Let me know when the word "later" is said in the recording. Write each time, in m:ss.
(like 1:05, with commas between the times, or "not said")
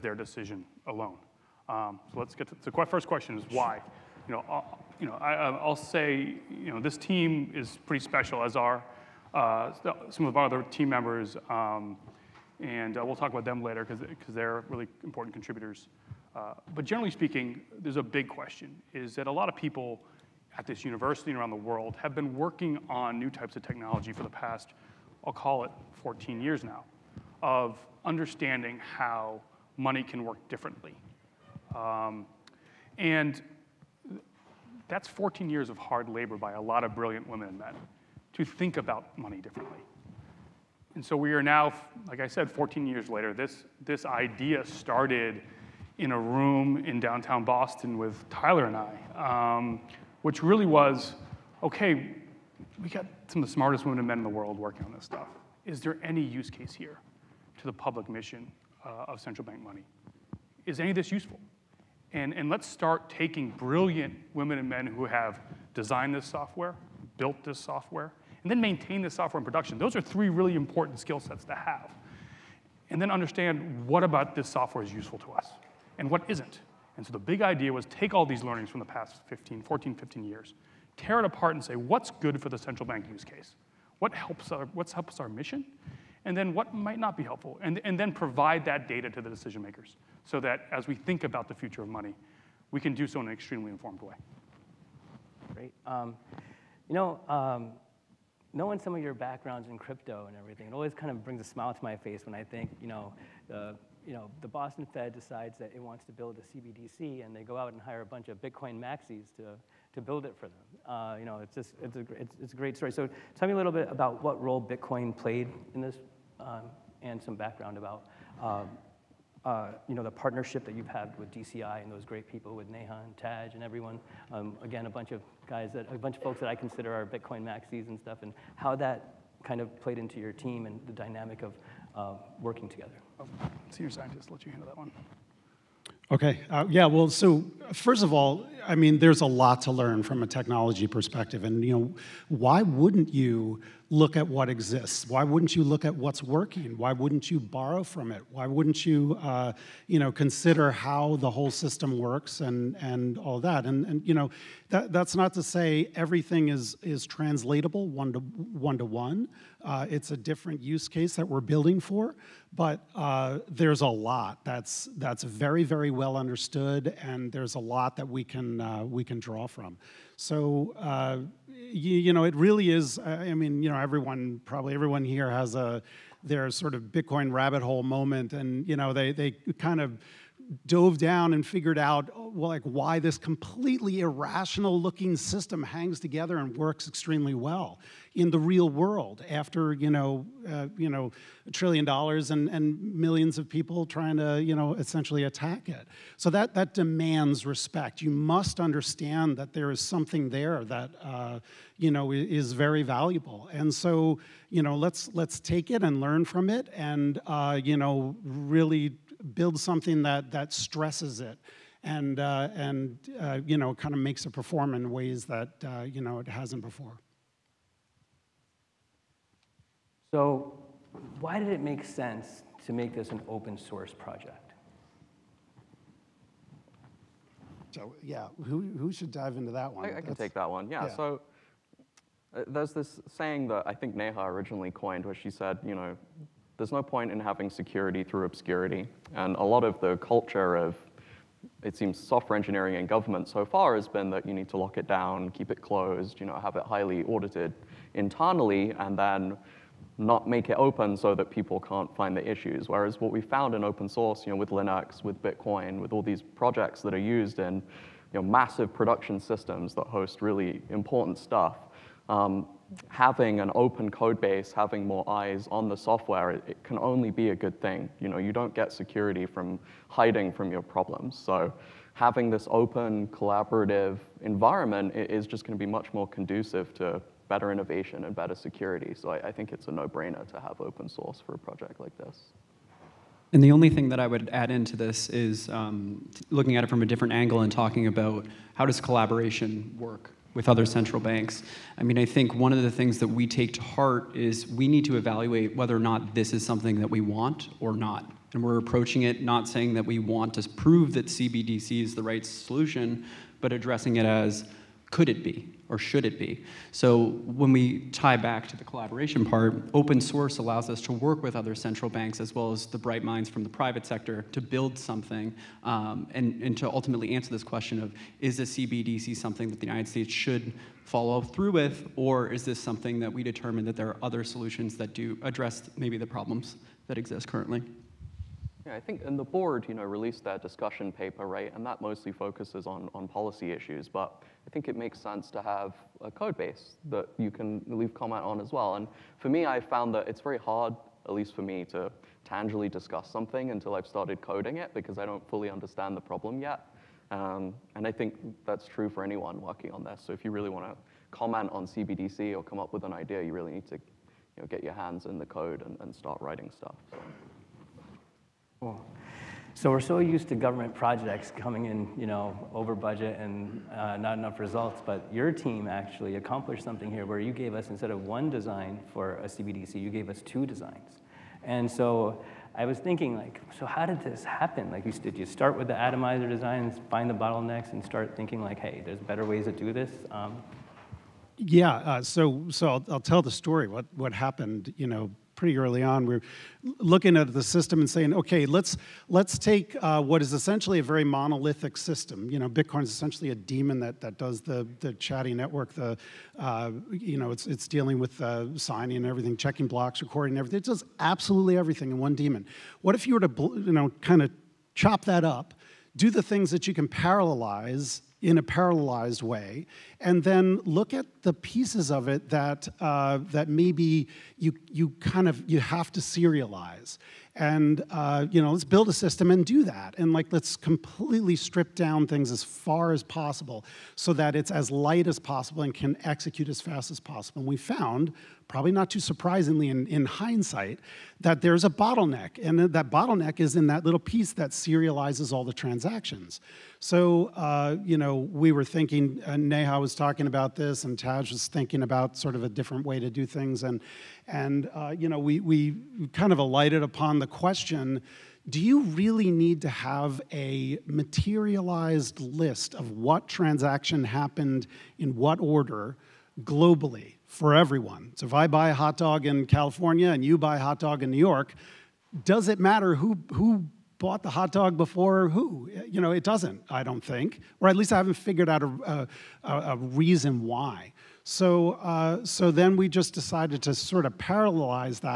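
0:13, 0:43.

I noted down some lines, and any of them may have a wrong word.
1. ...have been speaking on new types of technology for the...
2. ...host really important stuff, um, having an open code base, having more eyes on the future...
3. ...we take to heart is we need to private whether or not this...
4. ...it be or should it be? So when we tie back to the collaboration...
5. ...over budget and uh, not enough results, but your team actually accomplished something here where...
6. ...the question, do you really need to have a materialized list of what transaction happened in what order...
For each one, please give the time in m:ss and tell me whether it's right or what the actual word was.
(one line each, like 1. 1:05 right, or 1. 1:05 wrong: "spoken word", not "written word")
1. 0:22 wrong: "working", not "speaking"
2. 4:19 wrong: "software", not "future"
3. 4:53 wrong: "evaluate", not "private"
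4. 5:05 right
5. 6:02 right
6. 7:27 right.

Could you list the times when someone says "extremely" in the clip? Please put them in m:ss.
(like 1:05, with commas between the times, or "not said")
1:33, 3:06.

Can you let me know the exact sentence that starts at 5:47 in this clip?
Um, and I think that's true for anyone working on this.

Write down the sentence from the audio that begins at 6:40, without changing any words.
It does absolutely everything in one daemon.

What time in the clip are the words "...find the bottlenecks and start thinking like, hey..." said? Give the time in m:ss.
6:16.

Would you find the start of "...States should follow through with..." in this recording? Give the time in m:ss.
5:19.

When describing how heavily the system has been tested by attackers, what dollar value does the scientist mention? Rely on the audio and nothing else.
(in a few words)
a trillion dollars.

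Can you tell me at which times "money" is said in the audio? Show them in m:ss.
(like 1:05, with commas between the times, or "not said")
0:29, 0:39, 0:59, 1:31.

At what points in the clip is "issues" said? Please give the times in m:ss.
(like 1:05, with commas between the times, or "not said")
4:12, 5:33.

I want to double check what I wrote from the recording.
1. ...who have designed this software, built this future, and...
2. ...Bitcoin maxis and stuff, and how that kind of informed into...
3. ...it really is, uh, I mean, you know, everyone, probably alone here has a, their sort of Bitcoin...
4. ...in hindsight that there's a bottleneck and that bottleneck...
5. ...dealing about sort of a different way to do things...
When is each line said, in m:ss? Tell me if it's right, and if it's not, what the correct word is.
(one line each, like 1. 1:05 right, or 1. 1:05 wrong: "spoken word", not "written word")
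1. 1:04 wrong: "software", not "future"
2. 2:07 wrong: "played", not "informed"
3. 2:52 wrong: "everyone", not "alone"
4. 7:09 right
5. 7:21 wrong: "thinking", not "dealing".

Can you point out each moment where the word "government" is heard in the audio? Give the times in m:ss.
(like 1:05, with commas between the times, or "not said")
4:02, 6:00.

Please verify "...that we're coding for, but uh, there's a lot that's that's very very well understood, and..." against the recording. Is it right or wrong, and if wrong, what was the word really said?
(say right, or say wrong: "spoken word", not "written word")
wrong: "building", not "coding".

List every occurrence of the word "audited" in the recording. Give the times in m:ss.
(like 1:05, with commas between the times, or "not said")
4:07.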